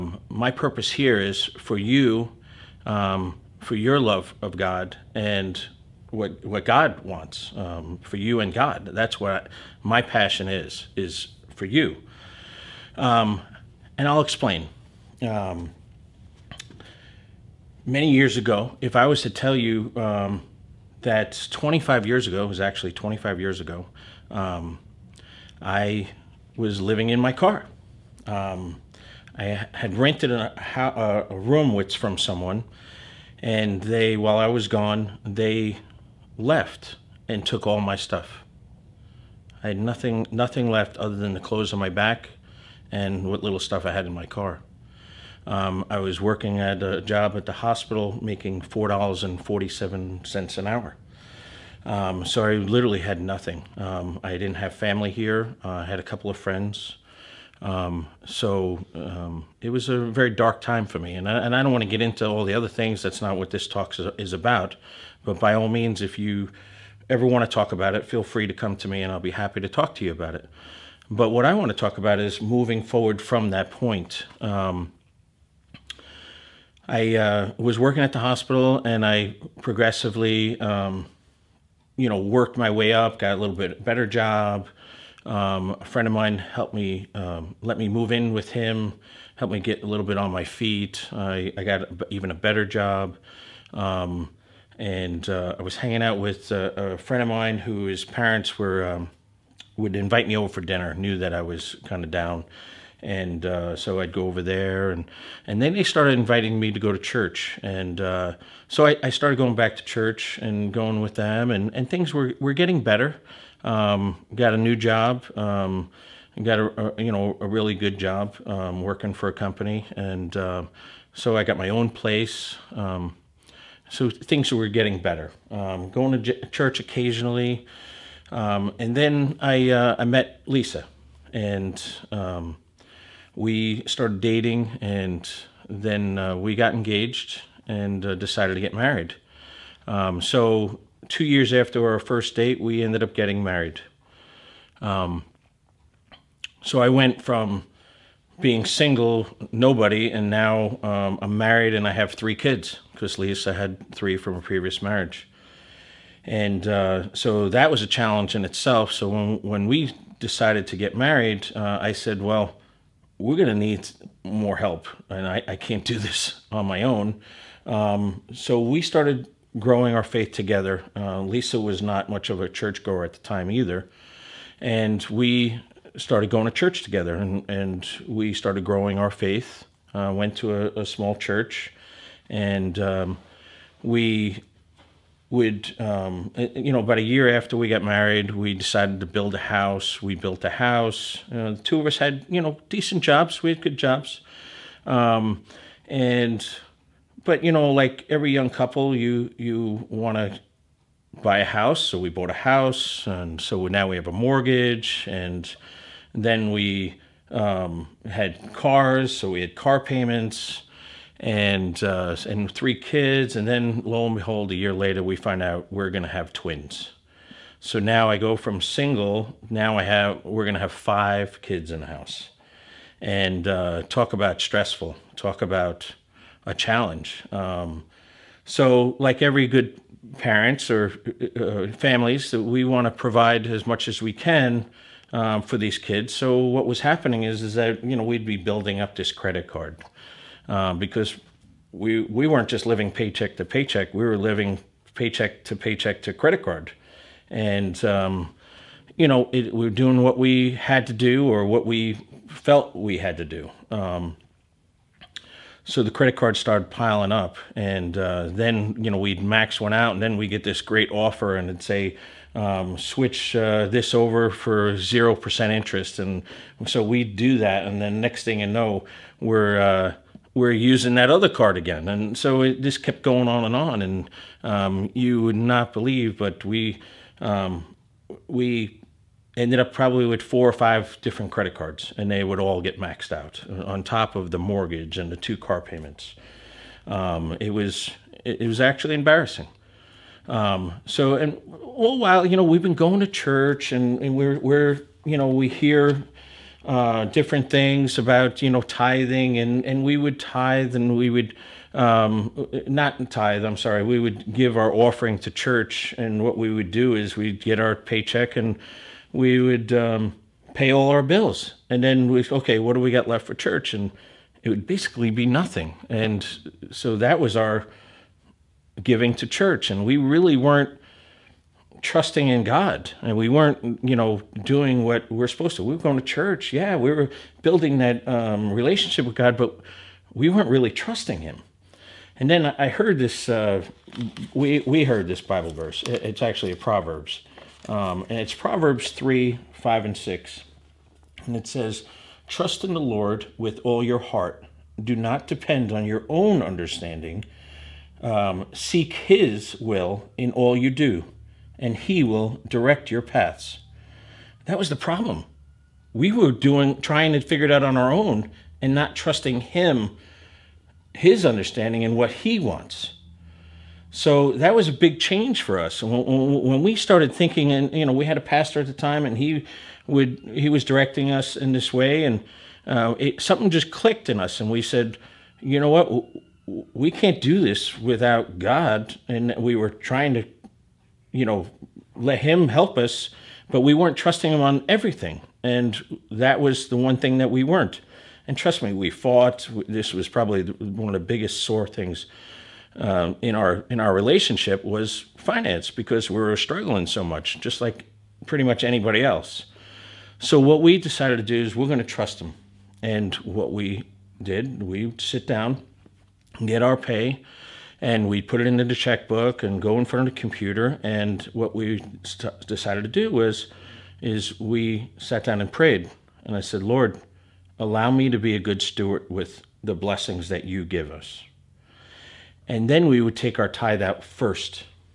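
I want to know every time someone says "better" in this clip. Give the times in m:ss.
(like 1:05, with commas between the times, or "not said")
1:23, 1:32, 1:52, 2:05.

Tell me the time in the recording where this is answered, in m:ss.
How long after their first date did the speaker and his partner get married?
2:21.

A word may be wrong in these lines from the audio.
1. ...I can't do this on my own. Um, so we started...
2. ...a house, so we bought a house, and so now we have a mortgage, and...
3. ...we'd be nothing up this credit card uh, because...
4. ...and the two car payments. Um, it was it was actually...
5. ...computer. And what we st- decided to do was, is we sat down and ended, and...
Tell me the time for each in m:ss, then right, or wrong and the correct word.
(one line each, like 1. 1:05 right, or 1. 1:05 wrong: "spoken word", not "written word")
1. 2:45 right
2. 3:21 right
3. 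3:58 wrong: "building", not "nothing"
4. 4:44 right
5. 6:50 wrong: "prayed", not "ended".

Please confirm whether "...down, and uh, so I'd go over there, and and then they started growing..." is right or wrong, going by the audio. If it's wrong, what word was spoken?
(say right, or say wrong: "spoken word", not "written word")
wrong: "inviting", not "growing".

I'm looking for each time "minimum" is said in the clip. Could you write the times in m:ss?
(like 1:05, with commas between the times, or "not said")
not said.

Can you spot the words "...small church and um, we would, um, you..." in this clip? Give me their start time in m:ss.
3:00.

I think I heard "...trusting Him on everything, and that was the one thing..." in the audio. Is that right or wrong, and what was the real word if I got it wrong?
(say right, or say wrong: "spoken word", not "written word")
right.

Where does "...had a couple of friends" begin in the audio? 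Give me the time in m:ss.
0:55.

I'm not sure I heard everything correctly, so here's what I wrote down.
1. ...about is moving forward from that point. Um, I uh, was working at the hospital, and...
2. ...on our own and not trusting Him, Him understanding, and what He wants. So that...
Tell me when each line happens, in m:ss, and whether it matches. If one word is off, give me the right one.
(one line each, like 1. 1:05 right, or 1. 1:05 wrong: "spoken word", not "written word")
1. 1:11 right
2. 5:57 wrong: "His", not "Him".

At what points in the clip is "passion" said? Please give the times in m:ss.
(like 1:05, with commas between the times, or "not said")
0:10.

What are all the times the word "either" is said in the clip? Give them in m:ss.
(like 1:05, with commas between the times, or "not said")
2:53.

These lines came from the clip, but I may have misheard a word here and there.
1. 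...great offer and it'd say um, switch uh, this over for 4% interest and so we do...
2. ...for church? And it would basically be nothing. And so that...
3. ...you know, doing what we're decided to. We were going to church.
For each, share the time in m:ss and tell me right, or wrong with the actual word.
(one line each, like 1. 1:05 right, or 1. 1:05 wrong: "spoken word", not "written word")
1. 4:20 wrong: "0", not "4"
2. 5:13 right
3. 5:23 wrong: "supposed", not "decided".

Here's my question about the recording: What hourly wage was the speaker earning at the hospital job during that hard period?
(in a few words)
$4.47.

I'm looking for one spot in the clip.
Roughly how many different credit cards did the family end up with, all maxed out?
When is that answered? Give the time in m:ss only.
4:40.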